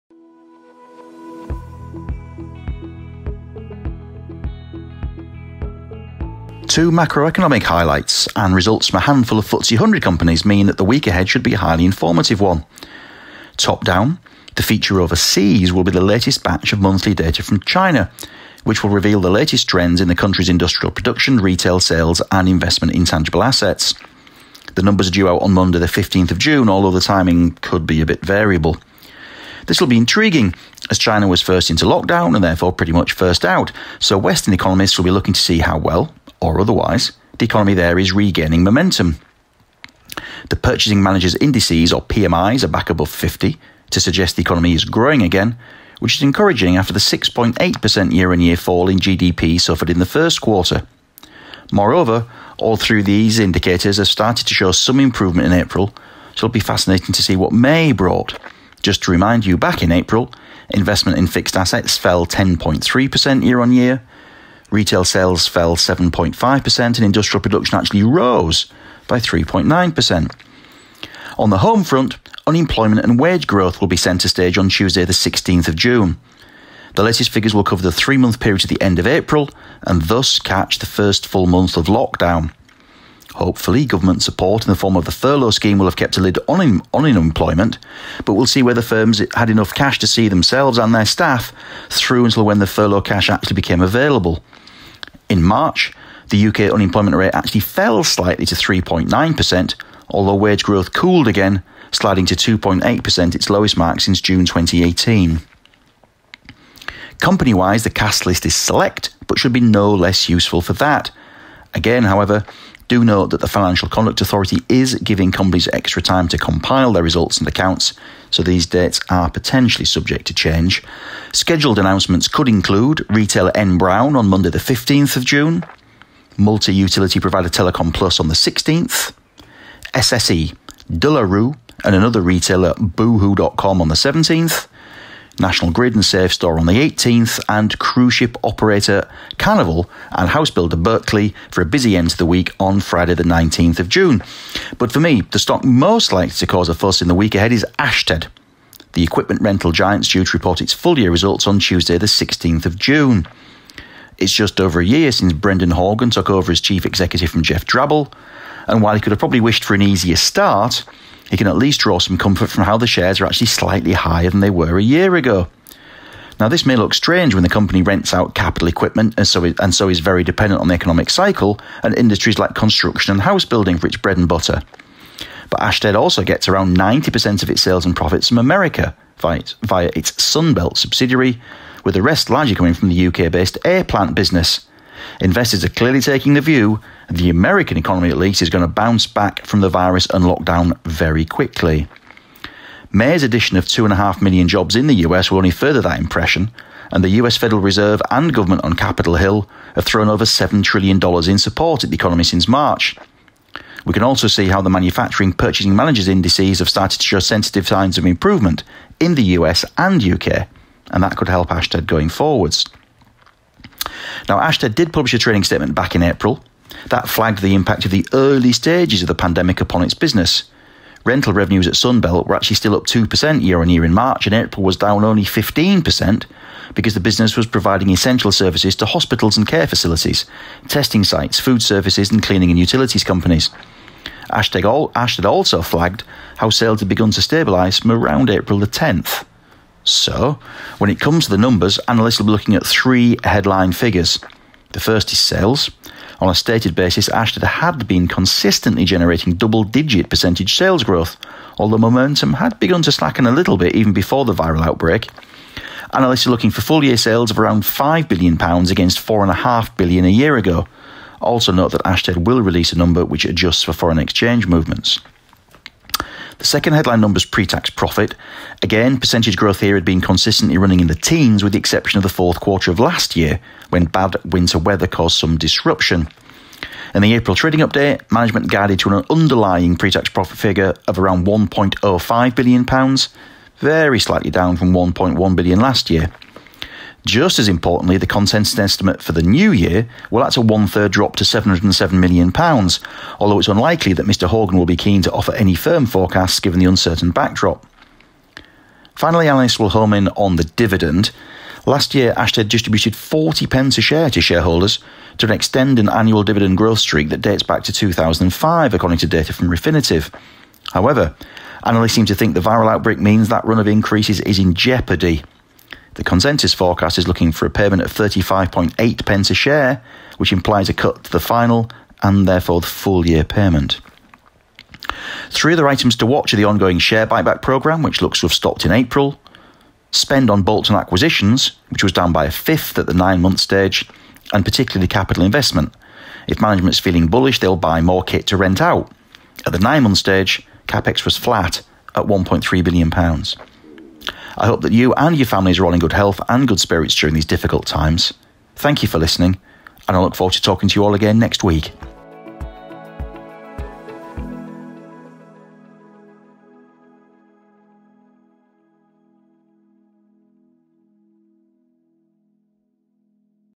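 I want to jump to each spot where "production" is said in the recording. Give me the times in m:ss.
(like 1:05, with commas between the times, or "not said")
0:20, 1:07.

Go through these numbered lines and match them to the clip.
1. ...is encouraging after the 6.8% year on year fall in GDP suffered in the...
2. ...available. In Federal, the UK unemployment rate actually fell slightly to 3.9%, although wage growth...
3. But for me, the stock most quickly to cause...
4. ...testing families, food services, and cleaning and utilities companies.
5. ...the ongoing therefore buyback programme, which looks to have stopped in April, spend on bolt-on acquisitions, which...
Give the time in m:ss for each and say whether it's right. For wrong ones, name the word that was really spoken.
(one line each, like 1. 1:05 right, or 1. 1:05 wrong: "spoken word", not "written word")
1. 0:46 right
2. 1:33 wrong: "March", not "Federal"
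3. 2:24 wrong: "likely", not "quickly"
4. 3:50 wrong: "sites", not "families"
5. 5:26 wrong: "share", not "therefore".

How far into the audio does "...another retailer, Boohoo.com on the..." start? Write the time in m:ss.
2:11.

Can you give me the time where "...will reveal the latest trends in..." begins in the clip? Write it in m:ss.
0:18.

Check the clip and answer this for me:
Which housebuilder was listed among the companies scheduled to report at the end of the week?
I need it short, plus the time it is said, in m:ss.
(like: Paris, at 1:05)
Berkeley, at 2:20.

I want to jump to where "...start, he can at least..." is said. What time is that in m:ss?
2:40.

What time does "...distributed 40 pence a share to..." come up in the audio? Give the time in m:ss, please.
5:02.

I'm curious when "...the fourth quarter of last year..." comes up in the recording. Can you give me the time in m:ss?
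4:32.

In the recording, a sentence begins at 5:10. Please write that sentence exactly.
However, analysts seem to think the viral outbreak means that run of increases is in jeopardy.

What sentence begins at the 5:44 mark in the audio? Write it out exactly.
I hope that you and your families are all in good health and good spirits during these difficult times.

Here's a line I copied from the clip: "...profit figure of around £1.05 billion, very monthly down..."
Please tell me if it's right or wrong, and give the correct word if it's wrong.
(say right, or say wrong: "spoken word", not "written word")
wrong: "slightly", not "monthly".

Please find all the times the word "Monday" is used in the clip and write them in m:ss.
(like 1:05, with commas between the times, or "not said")
0:25, 2:04.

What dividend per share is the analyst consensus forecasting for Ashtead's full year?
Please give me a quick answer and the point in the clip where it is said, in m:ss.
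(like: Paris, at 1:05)
35.8 pence, at 5:17.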